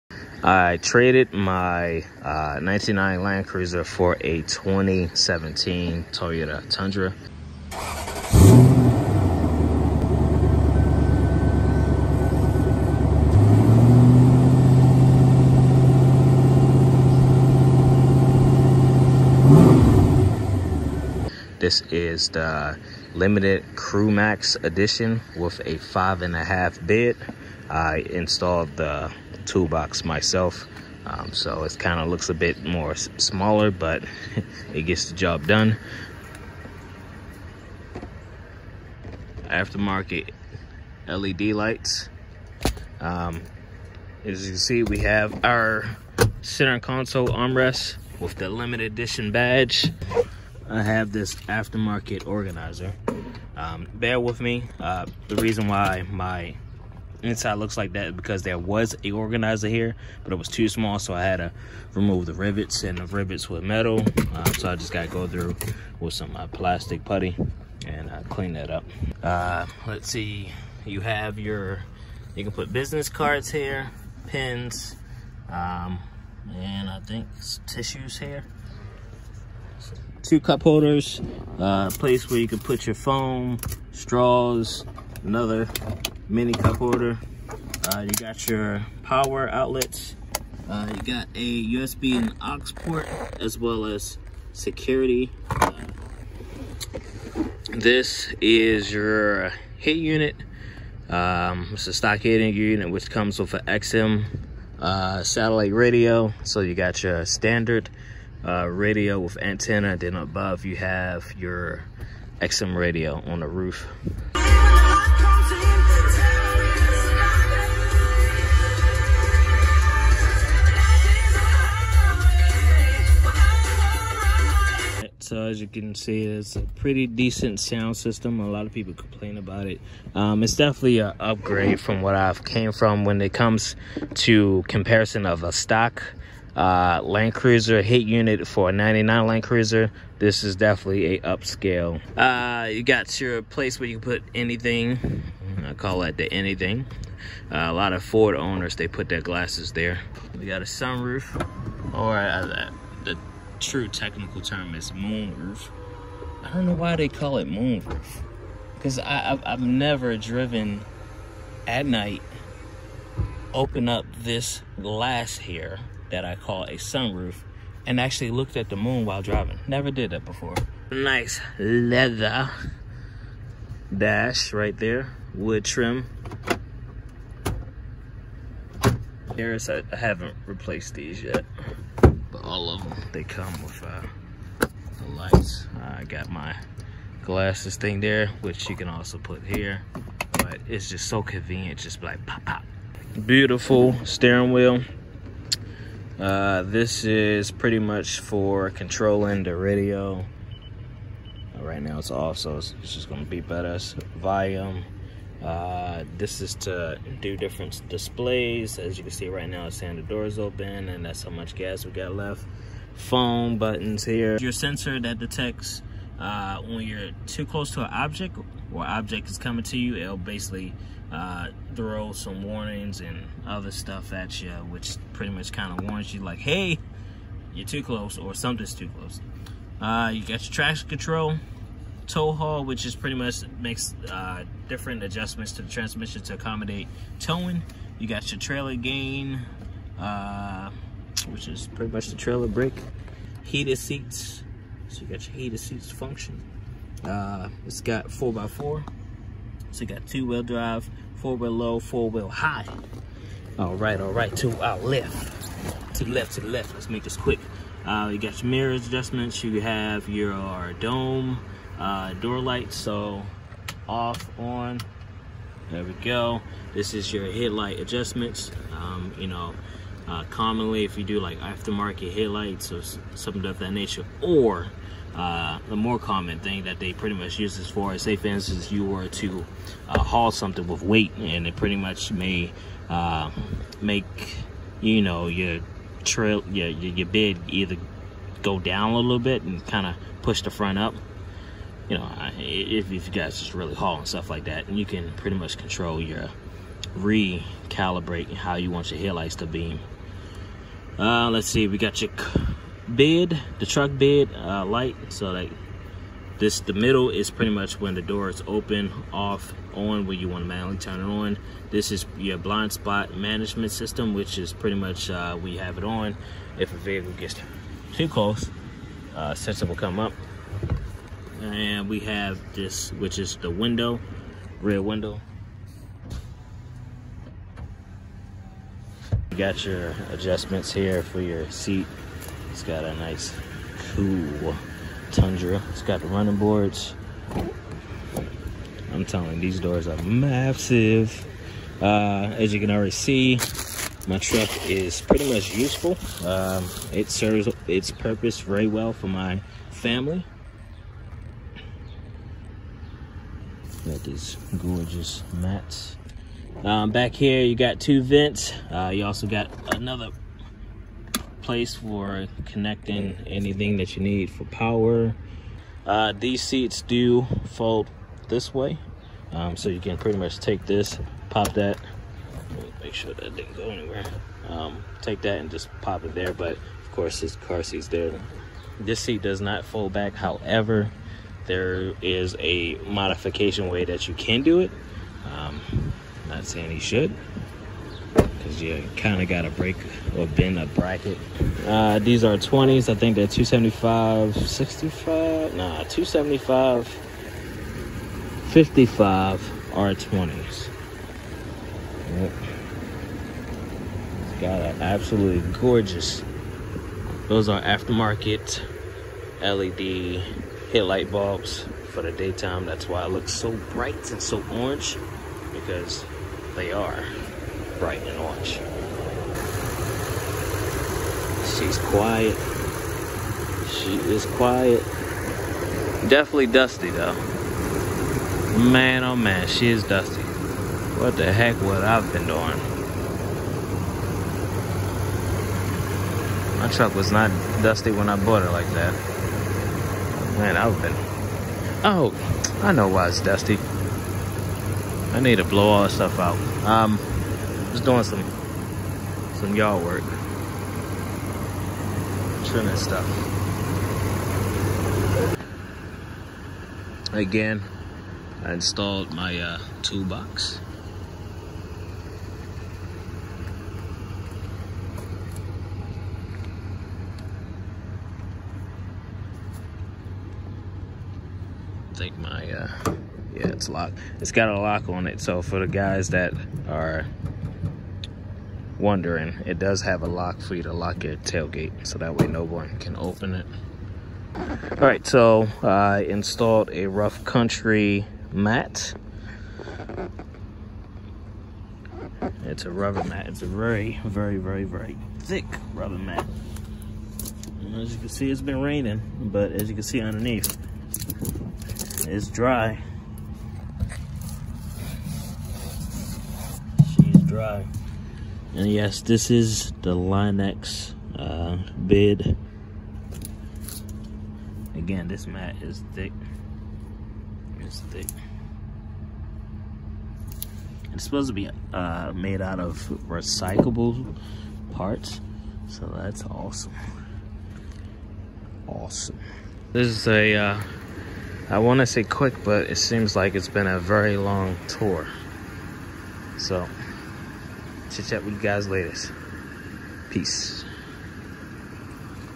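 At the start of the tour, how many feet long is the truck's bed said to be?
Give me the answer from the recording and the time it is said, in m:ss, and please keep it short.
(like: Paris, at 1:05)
5.5, at 0:25.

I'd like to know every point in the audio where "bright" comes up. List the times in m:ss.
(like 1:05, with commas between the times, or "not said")
6:53, 6:57.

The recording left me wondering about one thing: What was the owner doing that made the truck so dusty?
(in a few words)
yard work.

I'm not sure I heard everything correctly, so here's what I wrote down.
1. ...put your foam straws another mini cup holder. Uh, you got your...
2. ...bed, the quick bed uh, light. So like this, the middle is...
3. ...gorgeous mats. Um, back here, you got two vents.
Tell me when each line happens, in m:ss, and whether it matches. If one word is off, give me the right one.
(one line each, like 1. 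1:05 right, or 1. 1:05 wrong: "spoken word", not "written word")
1. 1:22 right
2. 5:02 wrong: "truck", not "quick"
3. 5:54 right.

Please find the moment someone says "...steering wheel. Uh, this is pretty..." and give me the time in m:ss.
3:14.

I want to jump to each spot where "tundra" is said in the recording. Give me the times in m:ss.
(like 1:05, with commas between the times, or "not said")
0:06, 5:35.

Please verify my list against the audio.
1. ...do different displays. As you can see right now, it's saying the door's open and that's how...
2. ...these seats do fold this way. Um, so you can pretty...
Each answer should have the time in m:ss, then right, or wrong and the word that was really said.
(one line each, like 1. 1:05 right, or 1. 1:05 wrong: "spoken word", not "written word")
1. 3:27 right
2. 6:06 right.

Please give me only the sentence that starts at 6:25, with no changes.
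Um, not saying you should, because you kind of got to break or bend a bracket.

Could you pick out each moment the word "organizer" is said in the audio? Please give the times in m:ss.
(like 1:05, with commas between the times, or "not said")
0:52, 0:59.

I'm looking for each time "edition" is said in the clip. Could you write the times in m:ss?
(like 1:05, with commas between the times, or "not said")
0:24, 0:48.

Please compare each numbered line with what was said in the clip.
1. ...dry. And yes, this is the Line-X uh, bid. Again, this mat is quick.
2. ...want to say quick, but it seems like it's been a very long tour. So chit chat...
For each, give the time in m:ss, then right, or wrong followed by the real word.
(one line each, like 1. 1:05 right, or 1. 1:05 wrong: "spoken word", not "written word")
1. 8:27 wrong: "thick", not "quick"
2. 8:51 right.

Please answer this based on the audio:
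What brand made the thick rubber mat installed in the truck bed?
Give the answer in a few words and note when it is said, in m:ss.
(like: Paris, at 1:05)
Rough Country, at 8:06.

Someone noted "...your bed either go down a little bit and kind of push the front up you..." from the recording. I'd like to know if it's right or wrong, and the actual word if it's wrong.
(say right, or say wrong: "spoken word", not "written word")
right.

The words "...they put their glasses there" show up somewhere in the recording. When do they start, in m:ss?
2:28.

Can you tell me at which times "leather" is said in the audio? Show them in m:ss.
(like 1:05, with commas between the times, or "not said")
2:51.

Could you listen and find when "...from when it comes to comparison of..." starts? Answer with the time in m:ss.
2:12.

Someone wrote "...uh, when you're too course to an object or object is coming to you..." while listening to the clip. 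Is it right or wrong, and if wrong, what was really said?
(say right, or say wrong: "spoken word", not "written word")
wrong: "close", not "course".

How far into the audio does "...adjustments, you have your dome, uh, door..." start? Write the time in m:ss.
4:18.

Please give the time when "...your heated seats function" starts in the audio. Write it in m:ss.
4:05.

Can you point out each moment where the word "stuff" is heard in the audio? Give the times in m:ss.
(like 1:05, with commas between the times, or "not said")
3:43, 4:54, 7:25, 7:32.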